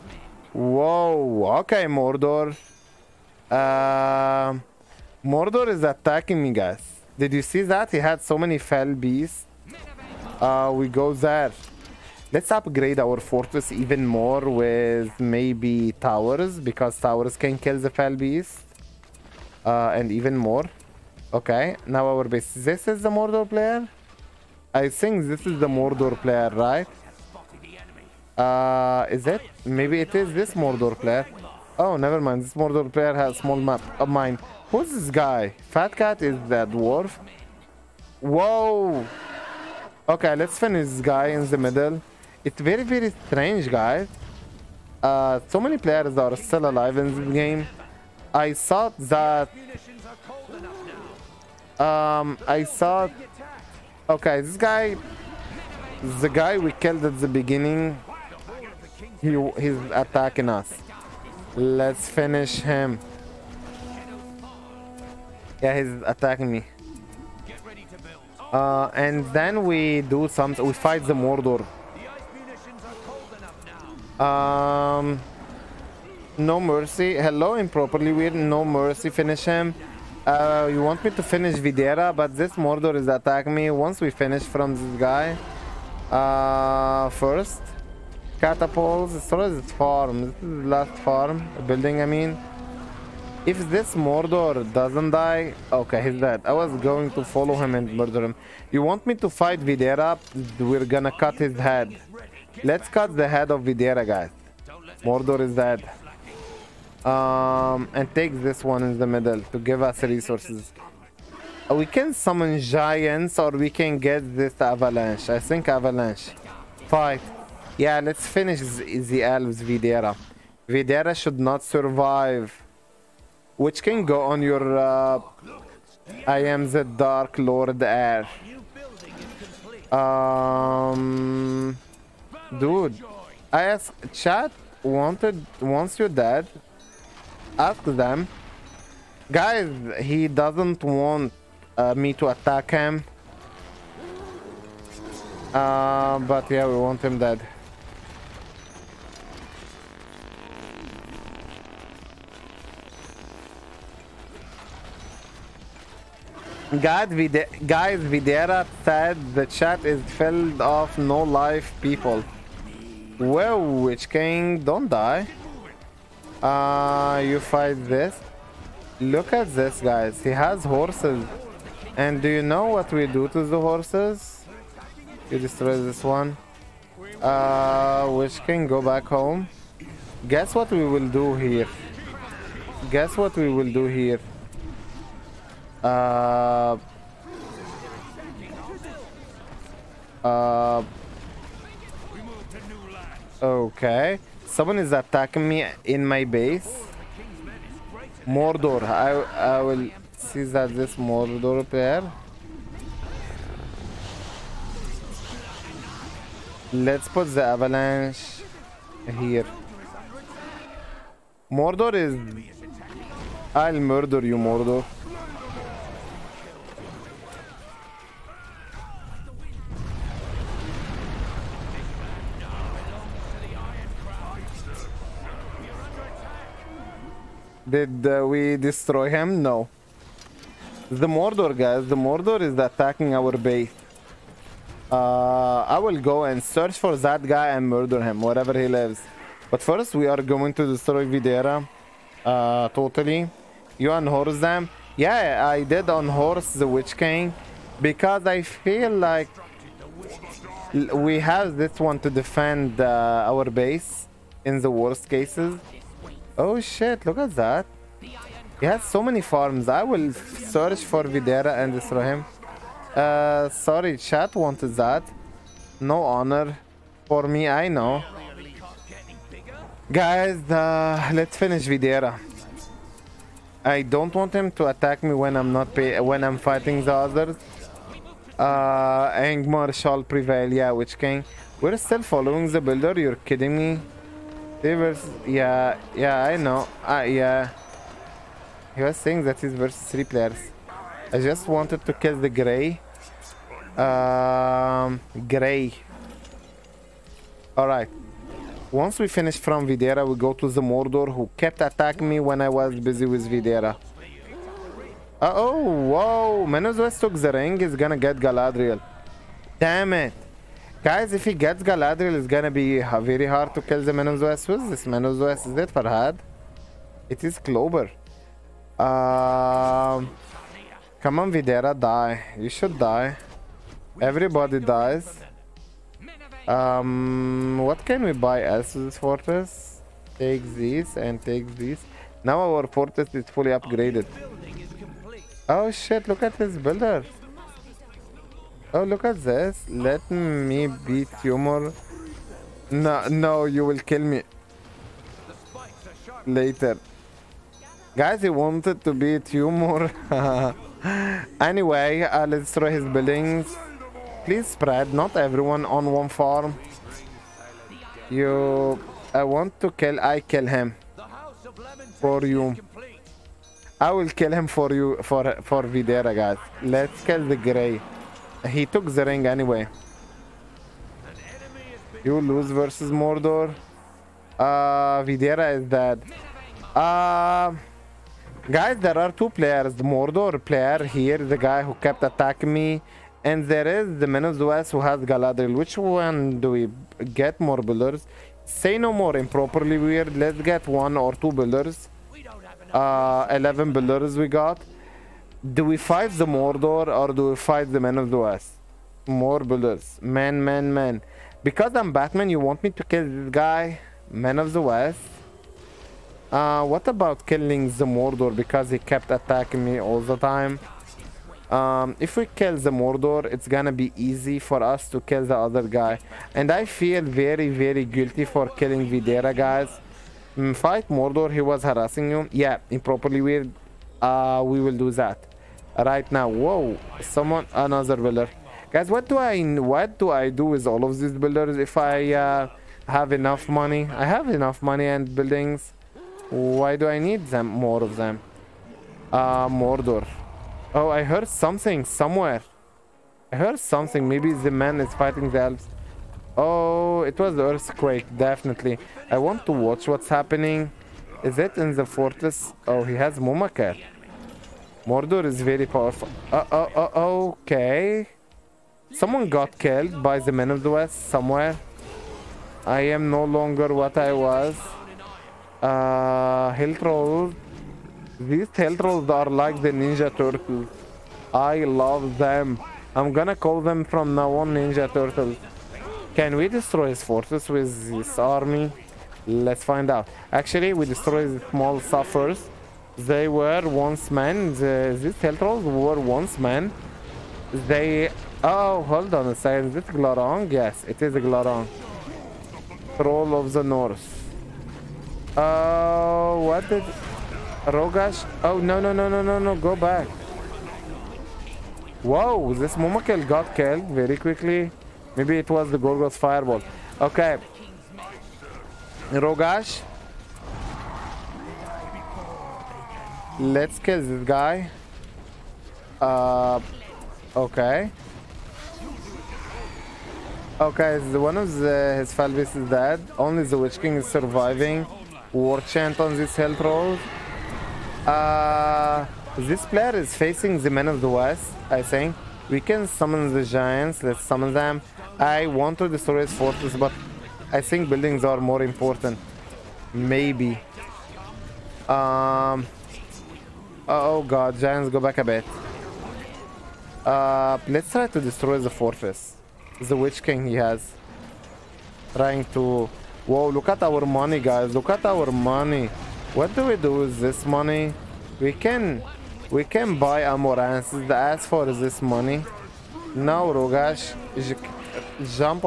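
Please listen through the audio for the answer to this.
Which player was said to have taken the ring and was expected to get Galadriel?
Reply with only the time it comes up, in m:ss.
5:06.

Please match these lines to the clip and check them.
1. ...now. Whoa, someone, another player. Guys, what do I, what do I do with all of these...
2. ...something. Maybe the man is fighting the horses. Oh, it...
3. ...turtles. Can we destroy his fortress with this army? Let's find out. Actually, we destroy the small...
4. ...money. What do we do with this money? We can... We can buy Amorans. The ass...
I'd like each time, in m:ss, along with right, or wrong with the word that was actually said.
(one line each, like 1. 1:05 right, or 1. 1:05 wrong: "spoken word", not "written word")
1. 7:06 wrong: "builder", not "player"
2. 7:23 wrong: "elves", not "horses"
3. 7:54 right
4. 9:15 right.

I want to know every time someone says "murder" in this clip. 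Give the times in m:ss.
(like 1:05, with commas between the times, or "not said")
1:37, 3:33, 3:57.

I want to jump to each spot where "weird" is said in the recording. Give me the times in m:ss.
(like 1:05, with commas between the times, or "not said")
1:18, 6:29, 7:03.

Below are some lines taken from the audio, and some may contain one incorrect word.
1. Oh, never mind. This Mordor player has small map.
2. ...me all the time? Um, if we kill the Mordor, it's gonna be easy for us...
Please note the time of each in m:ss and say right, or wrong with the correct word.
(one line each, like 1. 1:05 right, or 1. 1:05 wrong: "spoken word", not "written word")
1. 0:31 right
2. 6:49 right.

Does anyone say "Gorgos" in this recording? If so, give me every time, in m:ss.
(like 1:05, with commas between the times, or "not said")
8:25.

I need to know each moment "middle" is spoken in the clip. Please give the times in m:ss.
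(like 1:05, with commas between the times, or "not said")
0:41, 1:49.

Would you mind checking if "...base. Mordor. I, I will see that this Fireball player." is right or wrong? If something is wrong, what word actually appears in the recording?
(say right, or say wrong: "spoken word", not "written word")
wrong: "Mordor", not "Fireball".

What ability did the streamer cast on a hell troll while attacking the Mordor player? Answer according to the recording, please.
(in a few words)
War Chant.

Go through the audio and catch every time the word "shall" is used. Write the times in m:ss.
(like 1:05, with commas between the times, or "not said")
4:39.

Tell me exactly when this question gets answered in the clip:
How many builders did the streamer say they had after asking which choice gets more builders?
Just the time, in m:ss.
6:33.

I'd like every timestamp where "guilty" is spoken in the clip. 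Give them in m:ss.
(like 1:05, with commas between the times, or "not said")
6:57.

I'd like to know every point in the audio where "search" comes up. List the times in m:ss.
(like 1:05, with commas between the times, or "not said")
3:56, 4:20.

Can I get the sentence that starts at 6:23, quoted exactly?
And there is the Men of the West who has Galadriel.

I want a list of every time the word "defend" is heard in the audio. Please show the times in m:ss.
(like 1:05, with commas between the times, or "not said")
4:12.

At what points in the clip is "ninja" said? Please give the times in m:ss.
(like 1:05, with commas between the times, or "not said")
7:49, 7:54.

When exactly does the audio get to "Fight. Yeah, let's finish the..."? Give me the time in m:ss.
1:56.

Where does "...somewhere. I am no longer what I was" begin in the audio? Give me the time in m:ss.
7:41.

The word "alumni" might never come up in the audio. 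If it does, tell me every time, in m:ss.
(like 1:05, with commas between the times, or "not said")
not said.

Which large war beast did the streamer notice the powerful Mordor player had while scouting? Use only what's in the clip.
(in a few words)
Mumaker.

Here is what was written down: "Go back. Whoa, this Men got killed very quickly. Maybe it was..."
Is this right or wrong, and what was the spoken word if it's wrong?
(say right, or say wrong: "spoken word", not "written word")
wrong: "Momokel", not "Men".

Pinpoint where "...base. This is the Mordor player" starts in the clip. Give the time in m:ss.
0:22.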